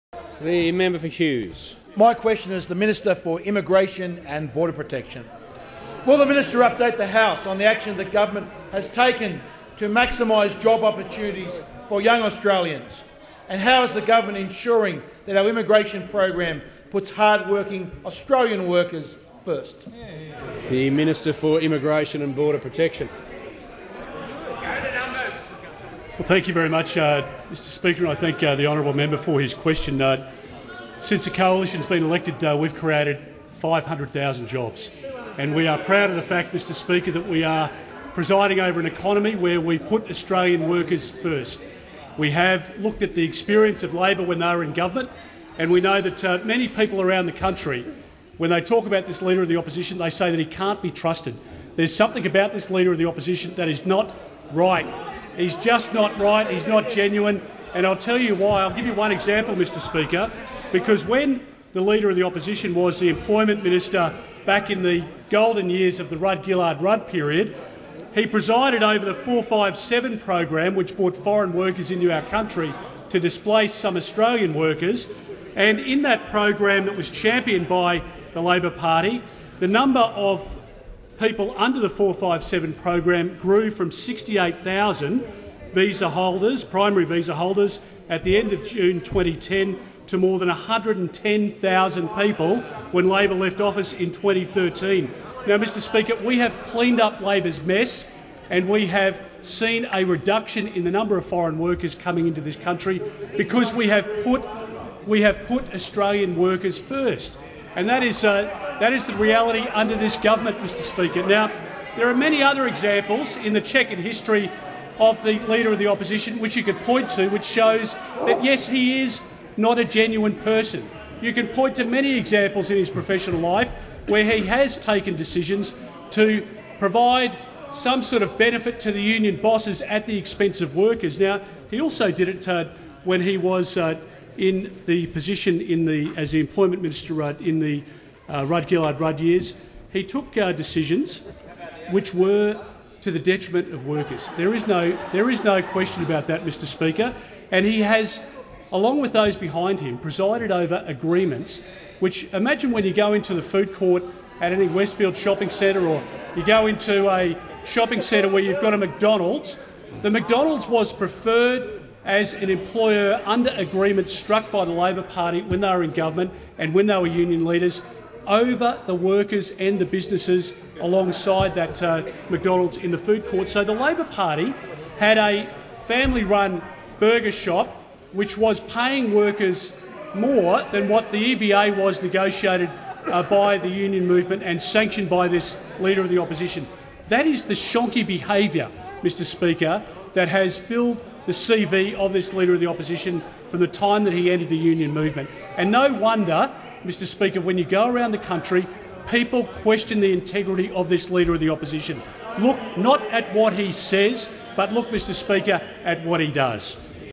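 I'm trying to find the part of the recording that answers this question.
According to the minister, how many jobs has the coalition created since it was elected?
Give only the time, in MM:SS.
00:33.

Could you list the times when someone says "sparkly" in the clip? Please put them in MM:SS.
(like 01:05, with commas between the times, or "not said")
not said.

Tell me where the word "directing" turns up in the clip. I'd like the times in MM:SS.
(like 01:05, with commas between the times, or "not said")
not said.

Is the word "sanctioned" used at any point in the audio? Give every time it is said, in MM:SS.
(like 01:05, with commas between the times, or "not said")
03:04.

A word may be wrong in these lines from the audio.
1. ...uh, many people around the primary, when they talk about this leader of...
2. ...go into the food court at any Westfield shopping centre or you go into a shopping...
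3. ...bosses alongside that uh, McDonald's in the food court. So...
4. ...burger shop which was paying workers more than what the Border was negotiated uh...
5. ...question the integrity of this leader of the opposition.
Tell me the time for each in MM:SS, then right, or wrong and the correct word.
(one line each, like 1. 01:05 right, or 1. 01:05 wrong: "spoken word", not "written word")
1. 00:46 wrong: "country", not "primary"
2. 02:32 right
3. 02:49 wrong: "businesses", not "bosses"
4. 02:56 wrong: "EBA", not "Border"
5. 03:19 right.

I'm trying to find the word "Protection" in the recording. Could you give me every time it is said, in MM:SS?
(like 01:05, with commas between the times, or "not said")
00:04, 00:22.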